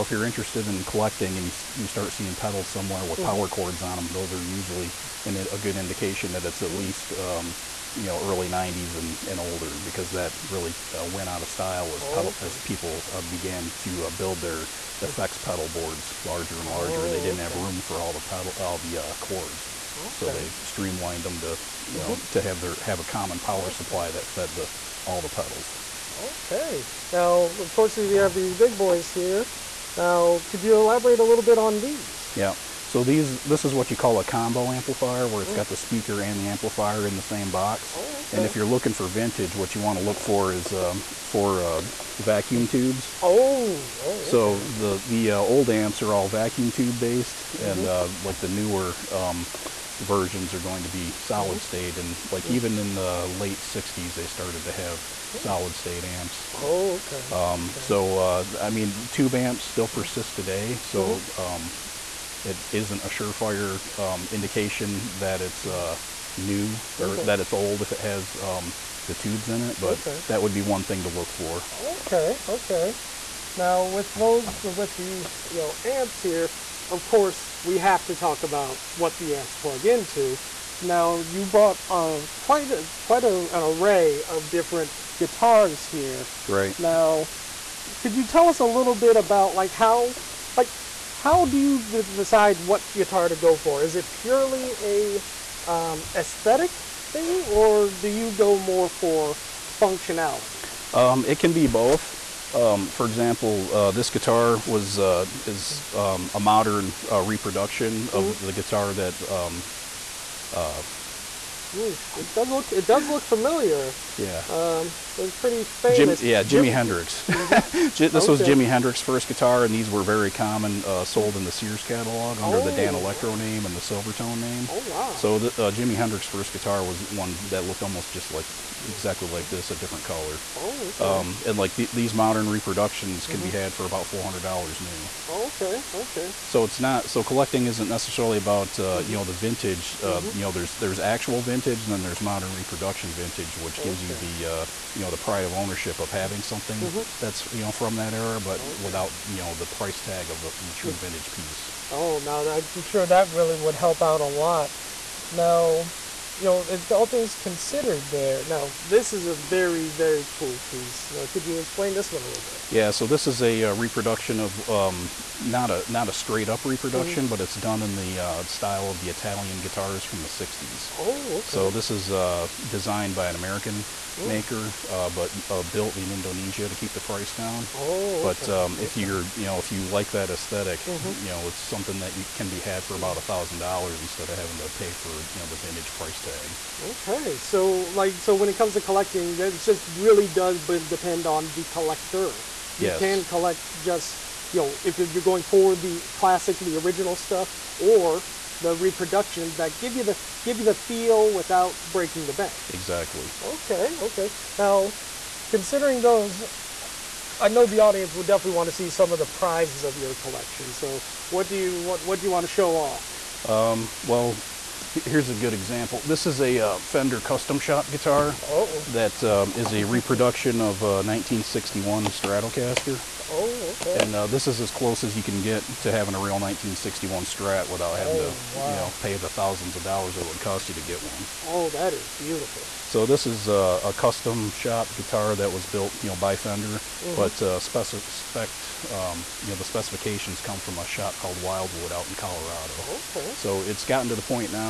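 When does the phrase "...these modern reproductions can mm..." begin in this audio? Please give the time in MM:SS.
02:11.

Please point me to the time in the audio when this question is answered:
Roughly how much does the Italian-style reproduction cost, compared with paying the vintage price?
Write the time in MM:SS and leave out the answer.
03:03.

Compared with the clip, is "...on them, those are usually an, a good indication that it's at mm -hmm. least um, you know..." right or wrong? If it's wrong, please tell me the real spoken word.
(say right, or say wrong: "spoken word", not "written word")
right.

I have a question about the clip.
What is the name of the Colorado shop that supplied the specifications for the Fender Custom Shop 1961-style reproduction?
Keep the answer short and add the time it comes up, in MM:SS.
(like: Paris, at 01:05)
Wildwood, at 04:01.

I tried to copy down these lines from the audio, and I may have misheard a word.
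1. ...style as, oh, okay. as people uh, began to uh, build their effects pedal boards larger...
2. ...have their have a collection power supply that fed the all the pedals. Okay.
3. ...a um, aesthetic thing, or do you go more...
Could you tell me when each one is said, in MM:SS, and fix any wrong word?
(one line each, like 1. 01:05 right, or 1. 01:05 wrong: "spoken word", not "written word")
1. 00:11 right
2. 00:22 wrong: "common", not "collection"
3. 01:34 right.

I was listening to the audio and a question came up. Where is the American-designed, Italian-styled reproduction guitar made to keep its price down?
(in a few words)
Indonesia.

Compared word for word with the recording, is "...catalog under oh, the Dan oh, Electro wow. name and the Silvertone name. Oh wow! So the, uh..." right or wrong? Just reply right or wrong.
right.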